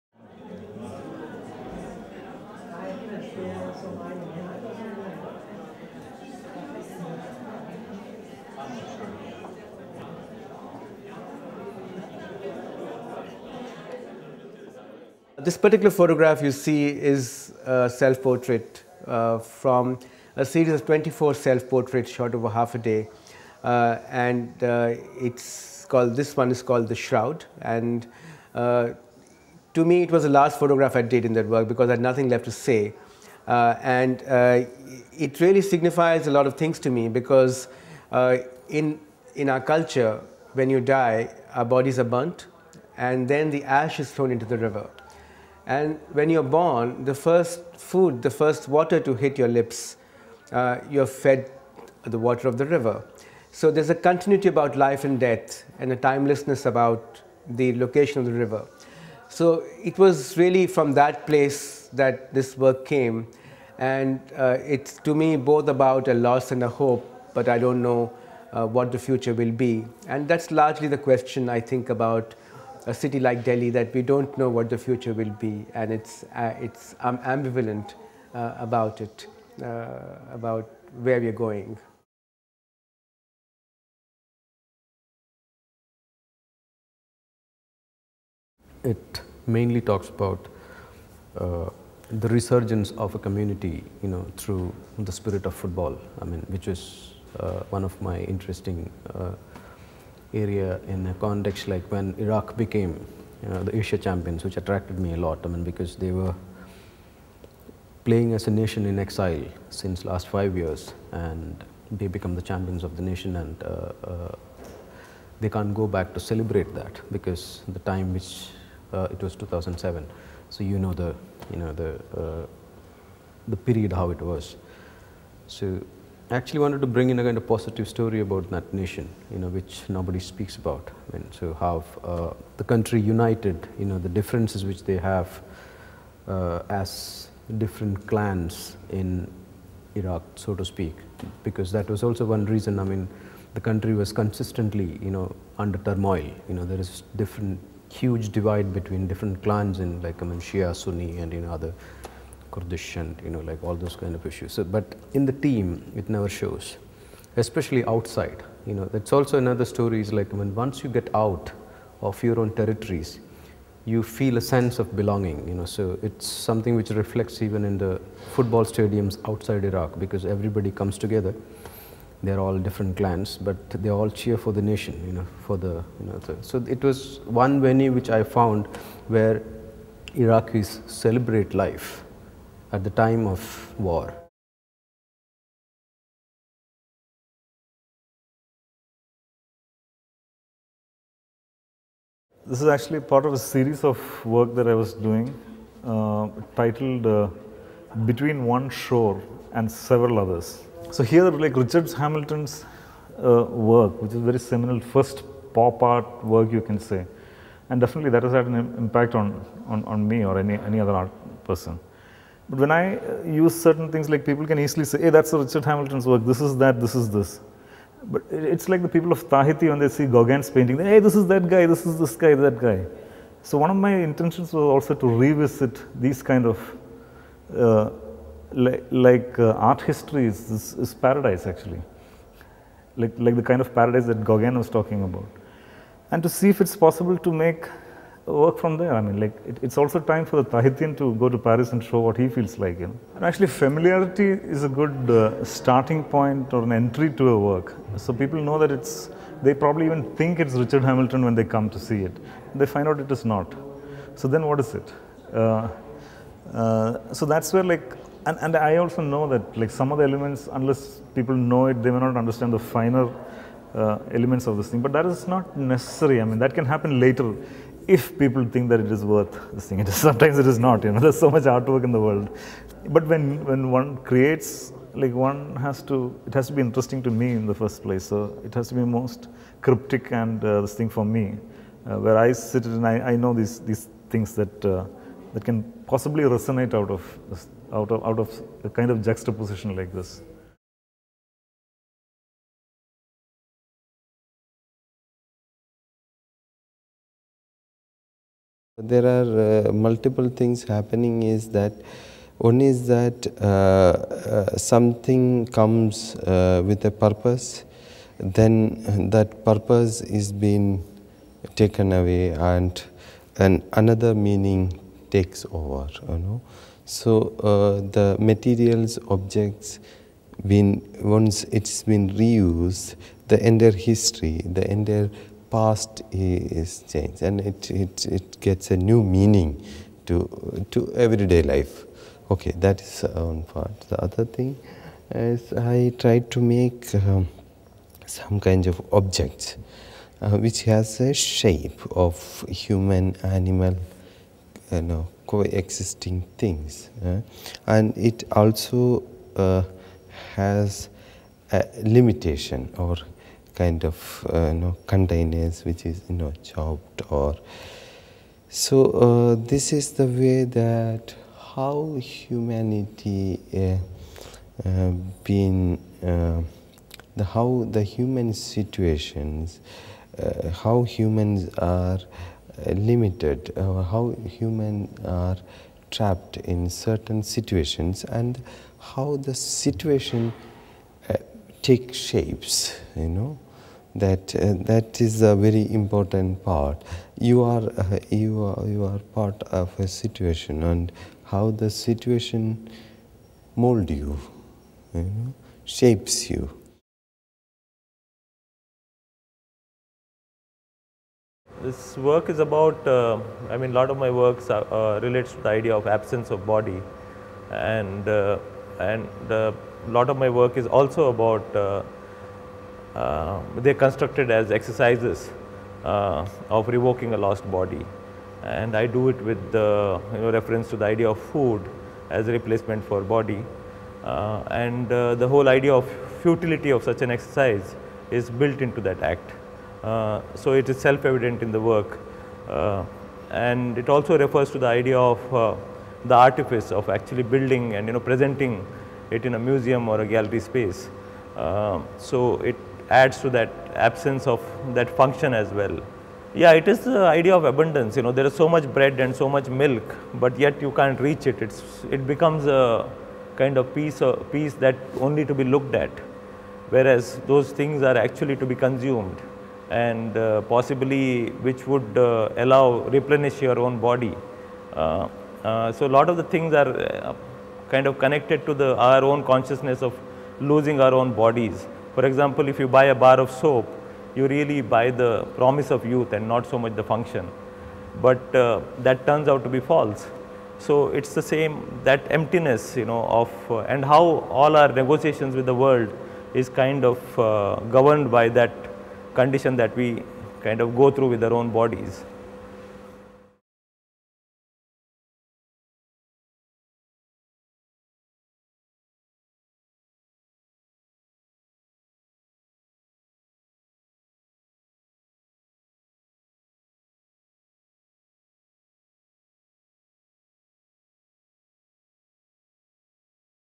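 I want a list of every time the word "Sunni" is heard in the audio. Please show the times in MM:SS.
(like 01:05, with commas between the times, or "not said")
02:30.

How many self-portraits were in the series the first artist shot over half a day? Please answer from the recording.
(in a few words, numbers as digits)
24.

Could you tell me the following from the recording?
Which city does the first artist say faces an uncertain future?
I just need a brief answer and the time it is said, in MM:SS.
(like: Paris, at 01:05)
Delhi, at 01:13.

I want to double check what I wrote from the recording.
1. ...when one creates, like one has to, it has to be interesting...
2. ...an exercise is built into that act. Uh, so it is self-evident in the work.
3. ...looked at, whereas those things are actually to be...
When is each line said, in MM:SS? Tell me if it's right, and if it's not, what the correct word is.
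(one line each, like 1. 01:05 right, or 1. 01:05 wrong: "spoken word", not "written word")
1. 04:33 right
2. 07:07 right
3. 07:35 right.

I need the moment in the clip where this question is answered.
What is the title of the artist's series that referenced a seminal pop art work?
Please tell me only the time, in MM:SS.
03:18.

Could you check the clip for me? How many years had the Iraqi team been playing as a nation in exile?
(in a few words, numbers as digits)
5.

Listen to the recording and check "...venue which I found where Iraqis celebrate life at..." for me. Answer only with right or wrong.
right.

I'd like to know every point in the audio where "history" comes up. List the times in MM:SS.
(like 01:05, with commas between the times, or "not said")
03:49, 05:23.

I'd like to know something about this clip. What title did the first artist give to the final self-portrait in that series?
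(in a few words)
The Shroud.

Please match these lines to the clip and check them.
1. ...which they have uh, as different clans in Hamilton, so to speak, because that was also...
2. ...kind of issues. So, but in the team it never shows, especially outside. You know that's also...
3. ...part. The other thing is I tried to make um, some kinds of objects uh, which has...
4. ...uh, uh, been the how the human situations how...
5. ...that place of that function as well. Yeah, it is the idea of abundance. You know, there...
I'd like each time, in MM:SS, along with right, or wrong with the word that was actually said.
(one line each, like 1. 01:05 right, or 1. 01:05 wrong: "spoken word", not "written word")
1. 02:14 wrong: "Iraq", not "Hamilton"
2. 02:33 right
3. 05:33 right
4. 06:03 right
5. 07:23 wrong: "absence", not "place".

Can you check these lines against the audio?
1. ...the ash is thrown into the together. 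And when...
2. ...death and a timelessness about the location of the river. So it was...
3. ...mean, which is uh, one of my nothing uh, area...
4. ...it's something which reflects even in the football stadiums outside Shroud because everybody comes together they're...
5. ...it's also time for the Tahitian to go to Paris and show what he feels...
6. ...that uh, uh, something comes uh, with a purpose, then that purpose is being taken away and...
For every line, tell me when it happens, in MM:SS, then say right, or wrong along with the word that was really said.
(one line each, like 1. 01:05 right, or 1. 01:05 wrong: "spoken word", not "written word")
1. 00:43 wrong: "river", not "together"
2. 00:55 right
3. 01:36 wrong: "interesting", not "nothing"
4. 02:46 wrong: "Iraq", not "Shroud"
5. 03:59 right
6. 05:02 right.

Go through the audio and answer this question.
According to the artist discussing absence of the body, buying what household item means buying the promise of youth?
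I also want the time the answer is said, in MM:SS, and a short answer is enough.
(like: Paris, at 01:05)
Soap, at 07:52.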